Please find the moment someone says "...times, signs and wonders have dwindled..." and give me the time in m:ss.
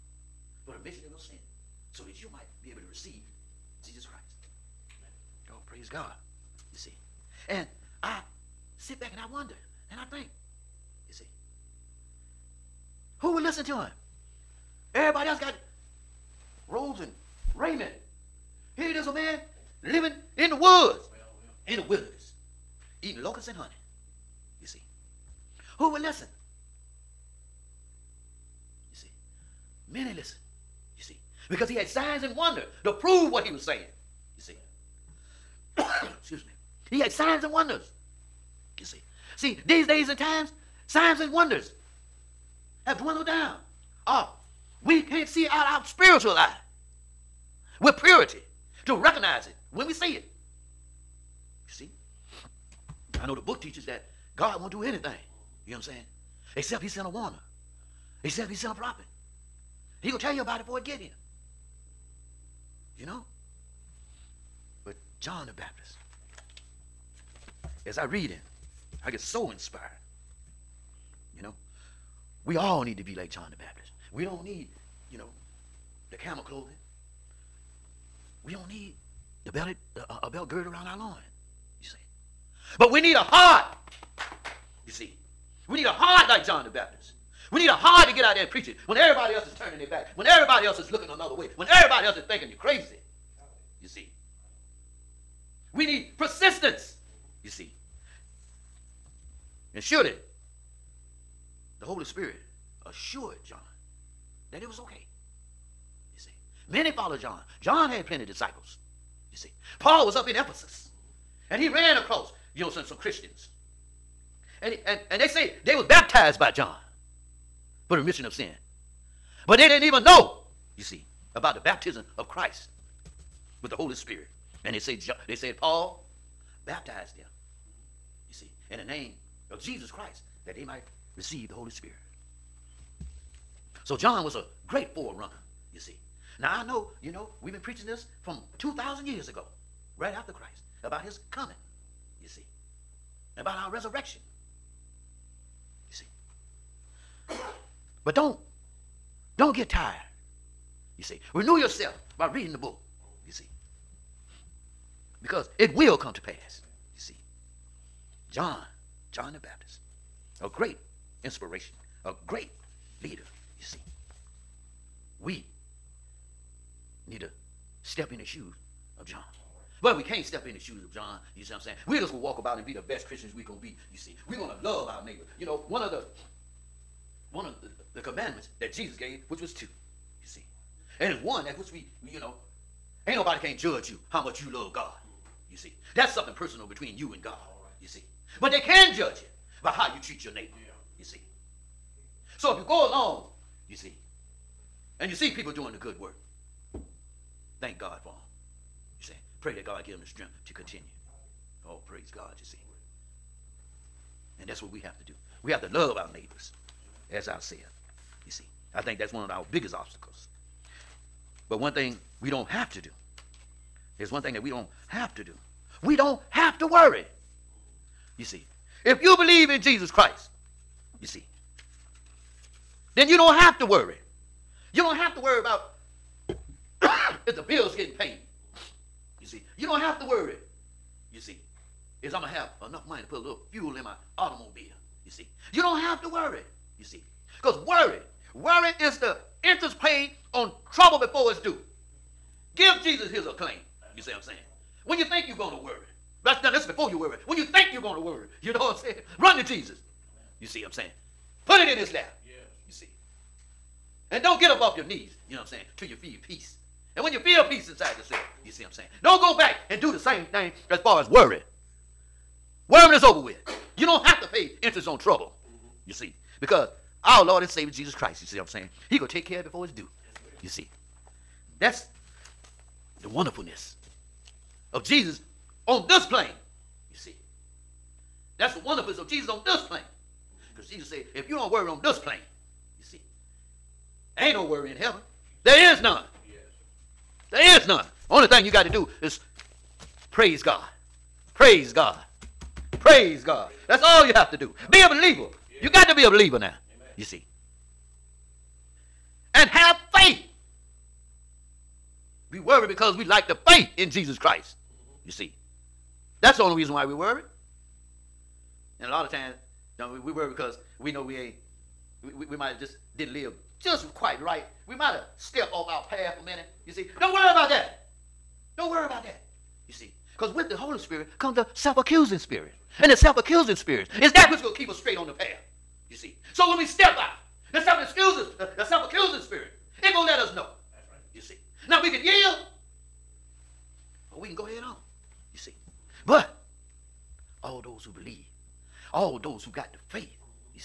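0:40.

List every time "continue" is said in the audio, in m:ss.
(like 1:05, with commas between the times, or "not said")
3:20.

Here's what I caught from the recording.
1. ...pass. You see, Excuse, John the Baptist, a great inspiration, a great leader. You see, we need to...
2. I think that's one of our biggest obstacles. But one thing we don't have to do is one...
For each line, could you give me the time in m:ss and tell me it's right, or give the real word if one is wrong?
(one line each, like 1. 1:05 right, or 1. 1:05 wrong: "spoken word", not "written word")
1. 2:36 wrong: "John", not "Excuse"
2. 3:28 right.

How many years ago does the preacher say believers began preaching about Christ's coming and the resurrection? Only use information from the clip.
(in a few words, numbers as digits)
2,000.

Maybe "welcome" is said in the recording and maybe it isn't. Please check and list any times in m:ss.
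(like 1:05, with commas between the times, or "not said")
not said.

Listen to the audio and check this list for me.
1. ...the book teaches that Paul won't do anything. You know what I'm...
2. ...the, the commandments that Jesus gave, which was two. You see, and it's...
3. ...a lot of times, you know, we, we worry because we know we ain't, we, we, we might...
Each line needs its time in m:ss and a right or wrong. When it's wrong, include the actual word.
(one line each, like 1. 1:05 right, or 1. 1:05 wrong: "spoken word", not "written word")
1. 0:53 wrong: "God", not "Paul"
2. 2:57 right
3. 5:08 right.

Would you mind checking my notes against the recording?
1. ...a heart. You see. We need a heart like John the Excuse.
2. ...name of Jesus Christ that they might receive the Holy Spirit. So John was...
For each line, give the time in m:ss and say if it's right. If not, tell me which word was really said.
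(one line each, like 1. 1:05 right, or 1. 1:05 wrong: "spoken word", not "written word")
1. 1:23 wrong: "Baptist", not "Excuse"
2. 2:08 right.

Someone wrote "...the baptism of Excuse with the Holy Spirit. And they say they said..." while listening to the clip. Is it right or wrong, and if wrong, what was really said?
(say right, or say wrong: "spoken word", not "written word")
wrong: "Christ", not "Excuse".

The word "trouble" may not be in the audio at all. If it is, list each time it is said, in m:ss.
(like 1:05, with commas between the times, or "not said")
4:00, 4:24.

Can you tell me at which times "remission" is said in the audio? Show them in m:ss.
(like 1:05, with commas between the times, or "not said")
0:00, 1:57.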